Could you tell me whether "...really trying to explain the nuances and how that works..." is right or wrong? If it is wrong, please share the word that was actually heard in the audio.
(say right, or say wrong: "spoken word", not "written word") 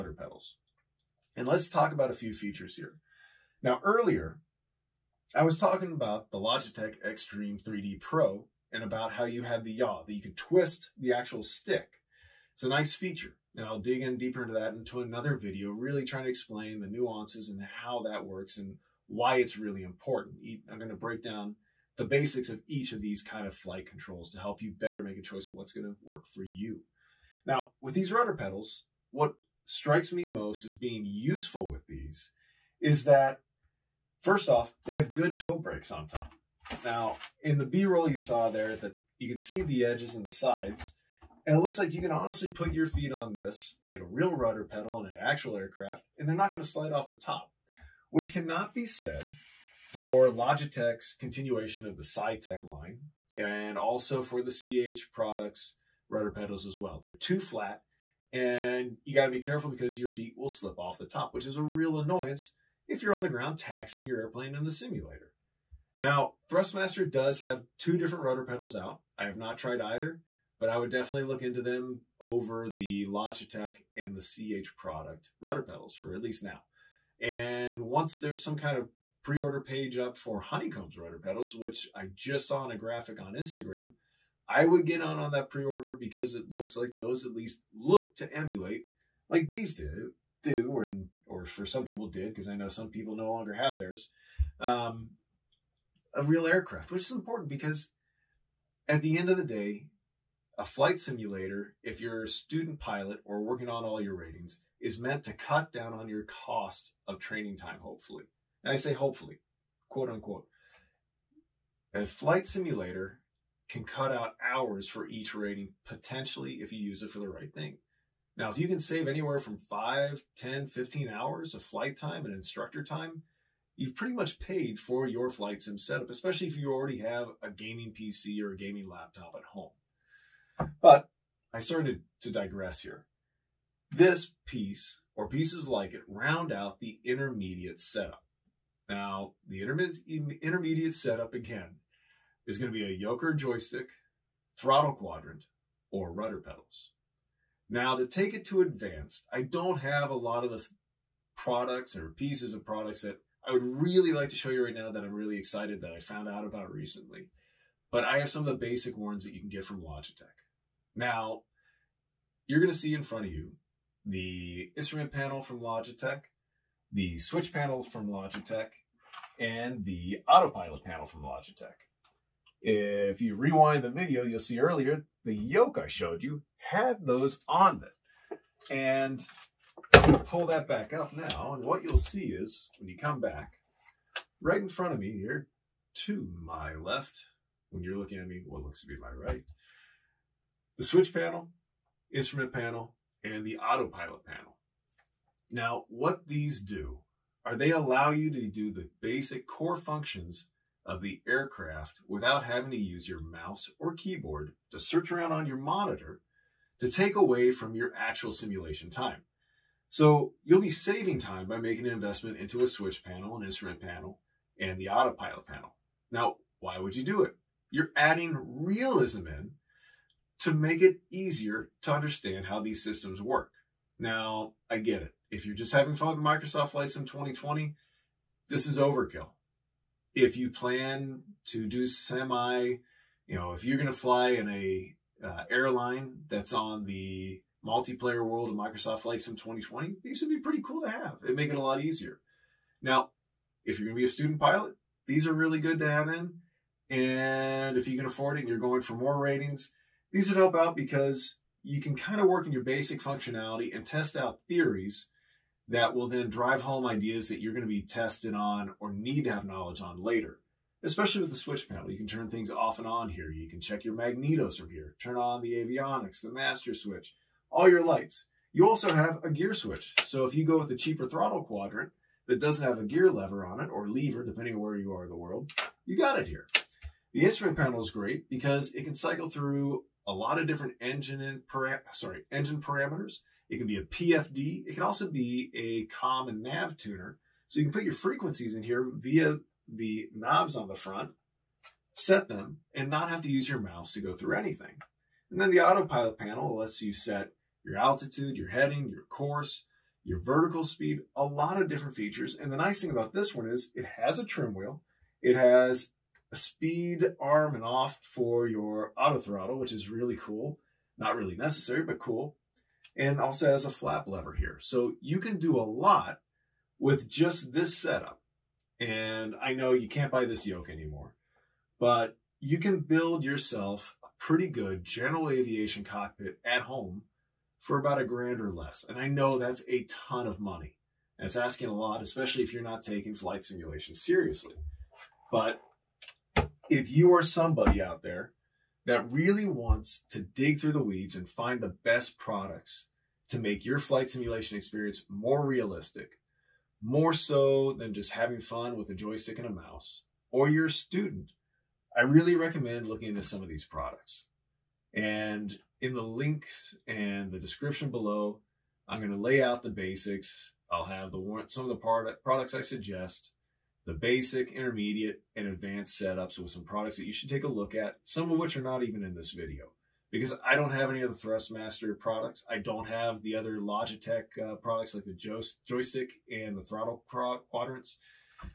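right.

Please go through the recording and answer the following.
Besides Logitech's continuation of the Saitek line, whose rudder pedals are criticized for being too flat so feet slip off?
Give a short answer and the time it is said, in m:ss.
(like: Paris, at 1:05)
CH Products, at 0:54.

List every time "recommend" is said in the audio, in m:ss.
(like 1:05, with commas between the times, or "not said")
5:52.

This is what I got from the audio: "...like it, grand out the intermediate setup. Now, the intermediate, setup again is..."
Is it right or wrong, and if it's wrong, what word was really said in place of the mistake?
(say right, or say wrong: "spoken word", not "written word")
wrong: "round", not "grand".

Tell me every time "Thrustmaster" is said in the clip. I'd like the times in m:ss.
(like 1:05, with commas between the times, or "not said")
1:06, 6:11.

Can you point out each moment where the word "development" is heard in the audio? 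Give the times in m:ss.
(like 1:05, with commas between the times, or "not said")
not said.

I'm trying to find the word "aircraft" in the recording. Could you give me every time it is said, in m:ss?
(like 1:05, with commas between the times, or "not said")
0:45, 1:36, 3:21.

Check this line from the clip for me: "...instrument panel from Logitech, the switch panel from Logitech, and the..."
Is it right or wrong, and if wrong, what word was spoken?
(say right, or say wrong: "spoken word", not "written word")
right.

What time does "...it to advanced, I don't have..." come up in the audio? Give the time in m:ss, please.
2:28.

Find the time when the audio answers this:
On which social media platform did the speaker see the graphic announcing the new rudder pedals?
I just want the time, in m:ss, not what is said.
1:23.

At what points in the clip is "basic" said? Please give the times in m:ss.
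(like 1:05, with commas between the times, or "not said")
0:22, 2:38, 3:19, 4:12, 5:59, 6:03.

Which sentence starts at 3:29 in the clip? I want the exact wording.
So you'll be saving time by making an investment into a switch panel, an instrument panel, and the autopilot panel.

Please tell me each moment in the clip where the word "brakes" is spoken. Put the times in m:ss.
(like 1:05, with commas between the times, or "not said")
0:35.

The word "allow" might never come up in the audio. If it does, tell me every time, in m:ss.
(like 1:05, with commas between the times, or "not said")
3:17.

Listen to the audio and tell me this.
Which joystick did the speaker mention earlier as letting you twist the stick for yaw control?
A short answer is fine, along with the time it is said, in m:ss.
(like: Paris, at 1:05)
Logitech Extreme 3D Pro, at 0:06.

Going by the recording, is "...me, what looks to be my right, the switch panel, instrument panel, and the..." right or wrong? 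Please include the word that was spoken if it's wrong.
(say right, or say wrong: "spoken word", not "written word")
right.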